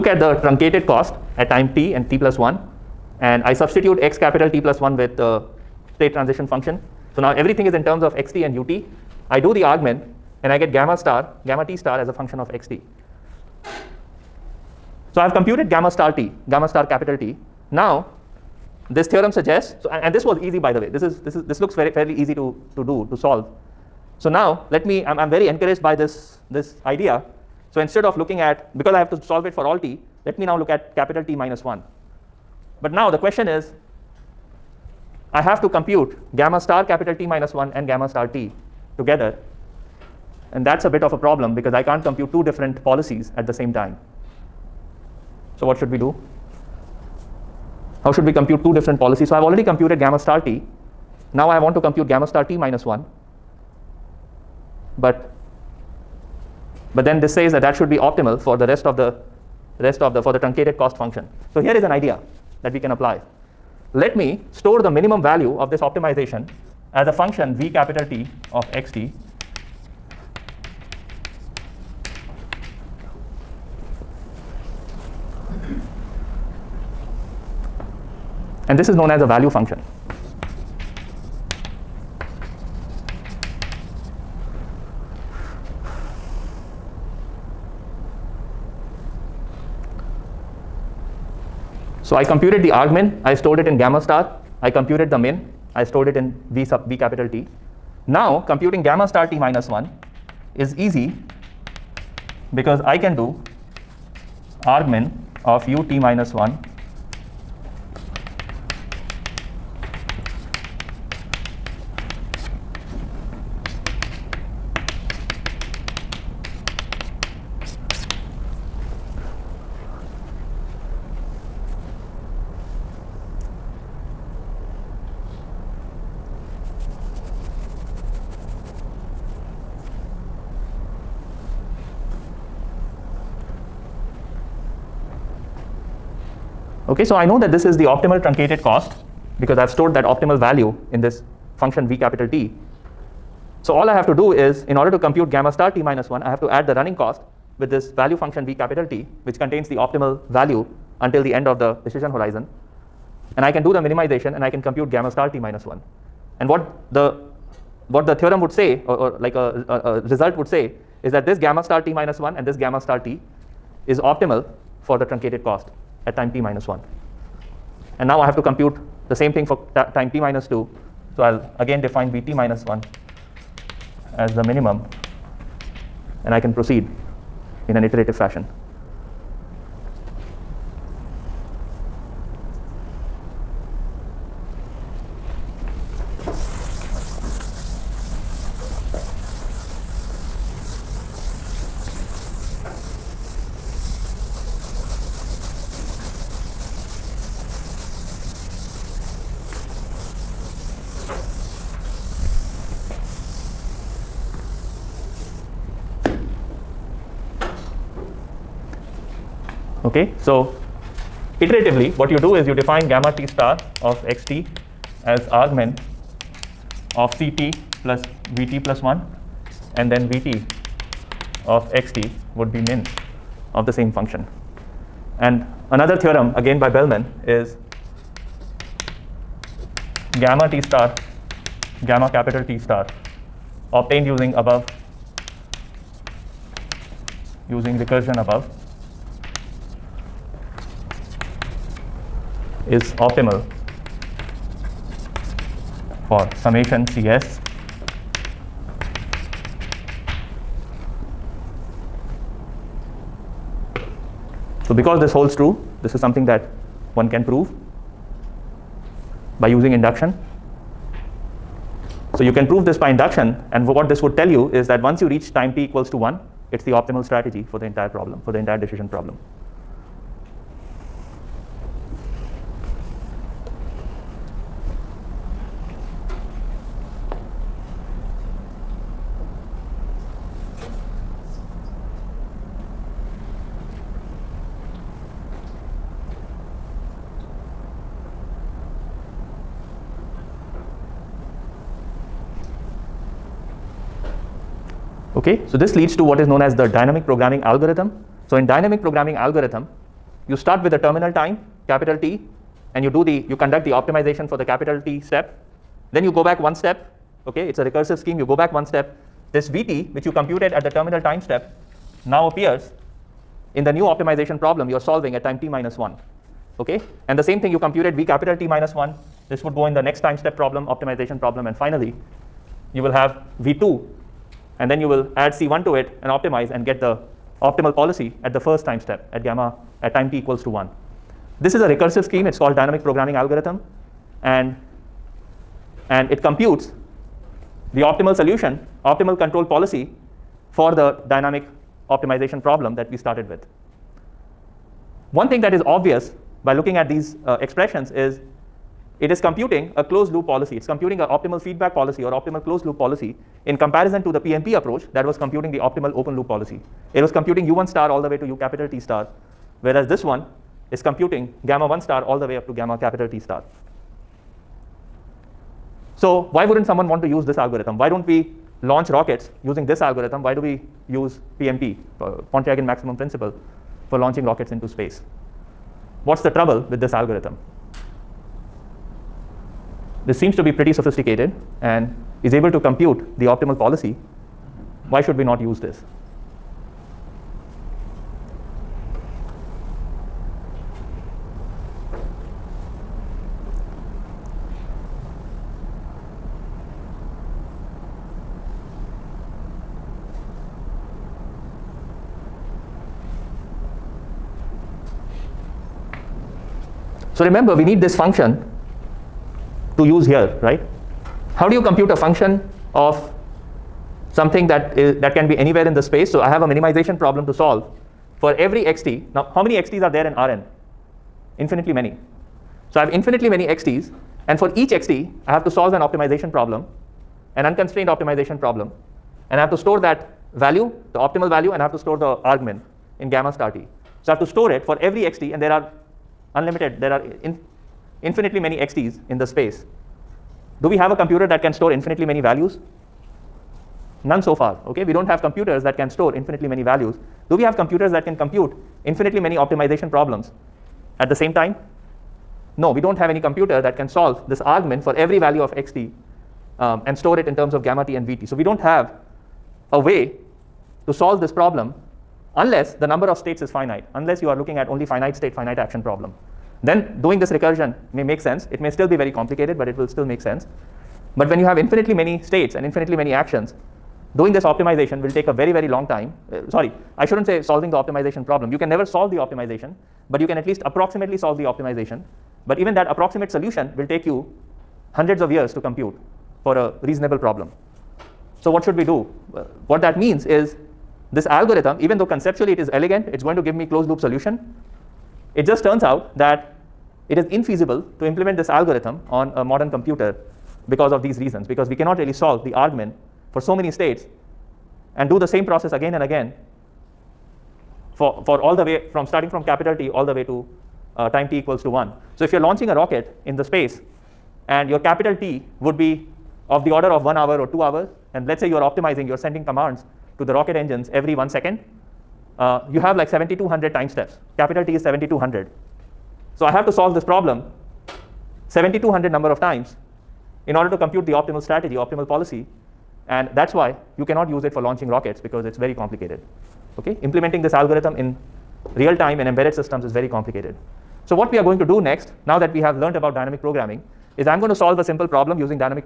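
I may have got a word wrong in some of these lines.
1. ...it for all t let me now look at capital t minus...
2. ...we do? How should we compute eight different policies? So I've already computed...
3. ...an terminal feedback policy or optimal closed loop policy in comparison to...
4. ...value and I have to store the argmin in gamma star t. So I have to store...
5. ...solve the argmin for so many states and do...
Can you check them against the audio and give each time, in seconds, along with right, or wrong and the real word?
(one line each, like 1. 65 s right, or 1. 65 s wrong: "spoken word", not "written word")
1. 29 s right
2. 45 s wrong: "two", not "eight"
3. 350 s wrong: "optimal", not "terminal"
4. 431 s right
5. 502 s right.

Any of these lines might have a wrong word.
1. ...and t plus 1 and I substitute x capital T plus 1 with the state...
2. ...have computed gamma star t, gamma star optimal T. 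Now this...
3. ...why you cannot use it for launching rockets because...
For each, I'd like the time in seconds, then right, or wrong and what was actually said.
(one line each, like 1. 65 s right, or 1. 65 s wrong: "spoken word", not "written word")
1. 1 s right
2. 15 s wrong: "capital", not "optimal"
3. 533 s right.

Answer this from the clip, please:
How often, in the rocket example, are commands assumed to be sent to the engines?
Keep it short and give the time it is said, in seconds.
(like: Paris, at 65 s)
every 1 second, at 520 s.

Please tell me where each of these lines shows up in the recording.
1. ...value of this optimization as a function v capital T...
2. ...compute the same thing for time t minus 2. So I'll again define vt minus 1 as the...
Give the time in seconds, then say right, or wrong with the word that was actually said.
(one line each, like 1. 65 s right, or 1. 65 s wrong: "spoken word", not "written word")
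1. 65 s right
2. 168 s right.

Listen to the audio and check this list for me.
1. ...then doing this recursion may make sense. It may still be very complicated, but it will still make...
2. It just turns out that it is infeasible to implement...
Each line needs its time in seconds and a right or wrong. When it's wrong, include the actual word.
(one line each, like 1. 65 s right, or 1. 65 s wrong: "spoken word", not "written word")
1. 466 s right
2. 495 s right.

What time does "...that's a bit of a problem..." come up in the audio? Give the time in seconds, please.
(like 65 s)
40 s.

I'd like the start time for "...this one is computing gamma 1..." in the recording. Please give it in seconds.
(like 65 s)
359 s.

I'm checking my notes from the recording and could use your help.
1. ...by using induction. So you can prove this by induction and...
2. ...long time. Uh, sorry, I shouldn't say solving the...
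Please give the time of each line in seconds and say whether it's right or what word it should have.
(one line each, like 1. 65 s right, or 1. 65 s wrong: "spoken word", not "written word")
1. 259 s right
2. 475 s right.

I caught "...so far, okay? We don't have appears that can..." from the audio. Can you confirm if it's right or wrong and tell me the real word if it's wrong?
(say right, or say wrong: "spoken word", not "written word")
wrong: "computers", not "appears".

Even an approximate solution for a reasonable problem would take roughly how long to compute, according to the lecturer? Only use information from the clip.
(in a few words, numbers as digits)
hundreds of years.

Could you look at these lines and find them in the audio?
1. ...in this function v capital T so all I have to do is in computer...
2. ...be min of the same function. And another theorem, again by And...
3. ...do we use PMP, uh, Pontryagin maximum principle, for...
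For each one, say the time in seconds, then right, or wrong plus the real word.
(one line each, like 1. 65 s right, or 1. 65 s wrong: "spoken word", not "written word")
1. 140 s wrong: "order", not "computer"
2. 222 s wrong: "Bellman", not "And"
3. 370 s right.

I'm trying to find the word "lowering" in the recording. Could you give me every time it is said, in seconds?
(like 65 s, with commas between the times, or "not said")
not said.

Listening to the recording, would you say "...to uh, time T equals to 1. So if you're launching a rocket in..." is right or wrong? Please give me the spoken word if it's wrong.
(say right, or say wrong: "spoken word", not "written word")
right.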